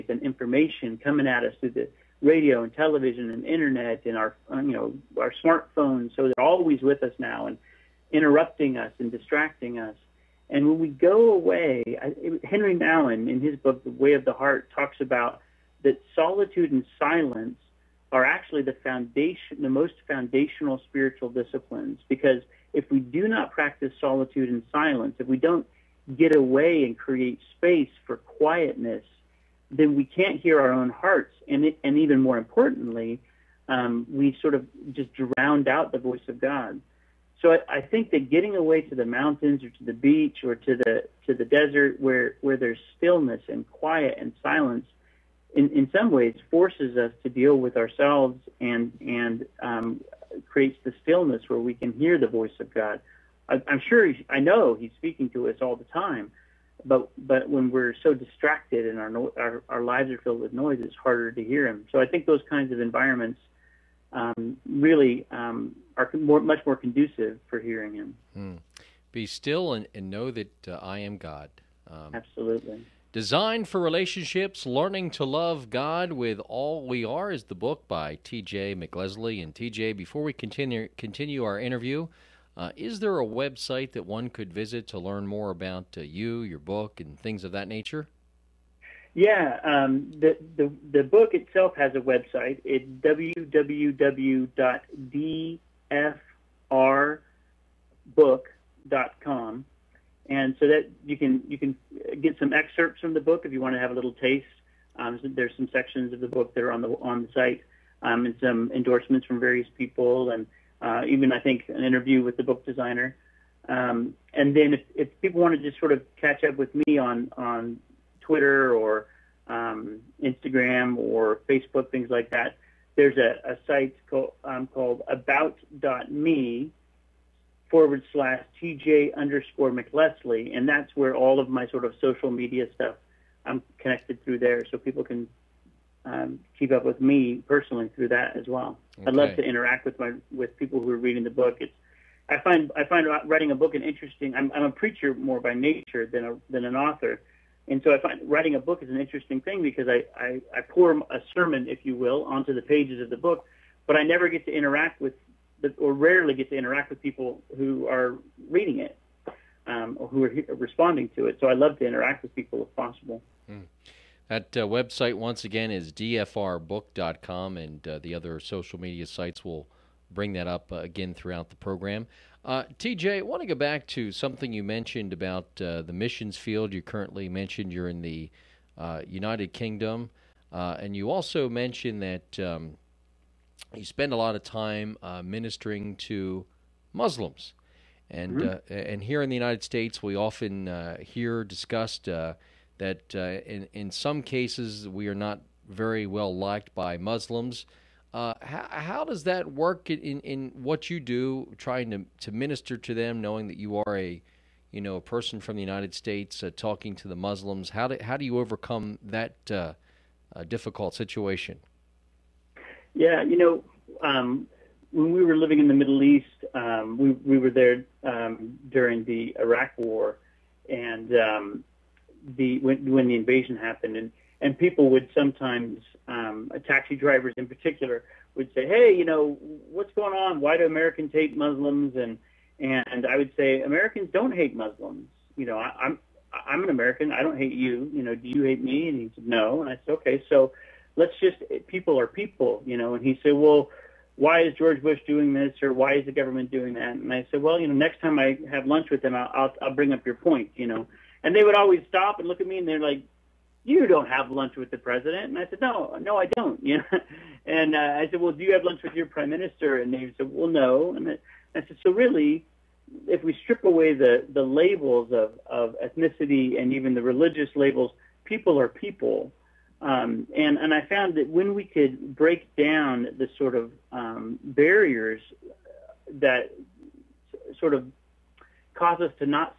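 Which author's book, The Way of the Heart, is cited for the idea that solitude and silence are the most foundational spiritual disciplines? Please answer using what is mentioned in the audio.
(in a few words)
Henry Nouwen.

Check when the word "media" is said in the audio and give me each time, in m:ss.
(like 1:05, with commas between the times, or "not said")
2:12, 2:48.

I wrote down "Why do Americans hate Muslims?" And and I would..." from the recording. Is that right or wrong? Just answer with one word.
right.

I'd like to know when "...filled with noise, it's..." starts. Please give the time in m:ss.
1:00.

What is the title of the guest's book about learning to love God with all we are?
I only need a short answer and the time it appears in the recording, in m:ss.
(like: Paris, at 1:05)
Designed for Relationships, at 1:13.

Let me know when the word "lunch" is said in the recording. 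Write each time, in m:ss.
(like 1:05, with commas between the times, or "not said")
4:08, 4:14, 4:18.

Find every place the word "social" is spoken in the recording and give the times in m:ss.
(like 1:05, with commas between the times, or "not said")
2:12, 2:48.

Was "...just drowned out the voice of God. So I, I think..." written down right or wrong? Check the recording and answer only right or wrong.
right.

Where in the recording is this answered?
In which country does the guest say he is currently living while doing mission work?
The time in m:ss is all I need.
2:59.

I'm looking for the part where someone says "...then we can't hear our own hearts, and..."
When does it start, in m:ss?
0:29.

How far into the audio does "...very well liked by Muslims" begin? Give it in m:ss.
3:15.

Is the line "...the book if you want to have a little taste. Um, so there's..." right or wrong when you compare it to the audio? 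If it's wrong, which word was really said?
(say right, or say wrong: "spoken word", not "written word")
right.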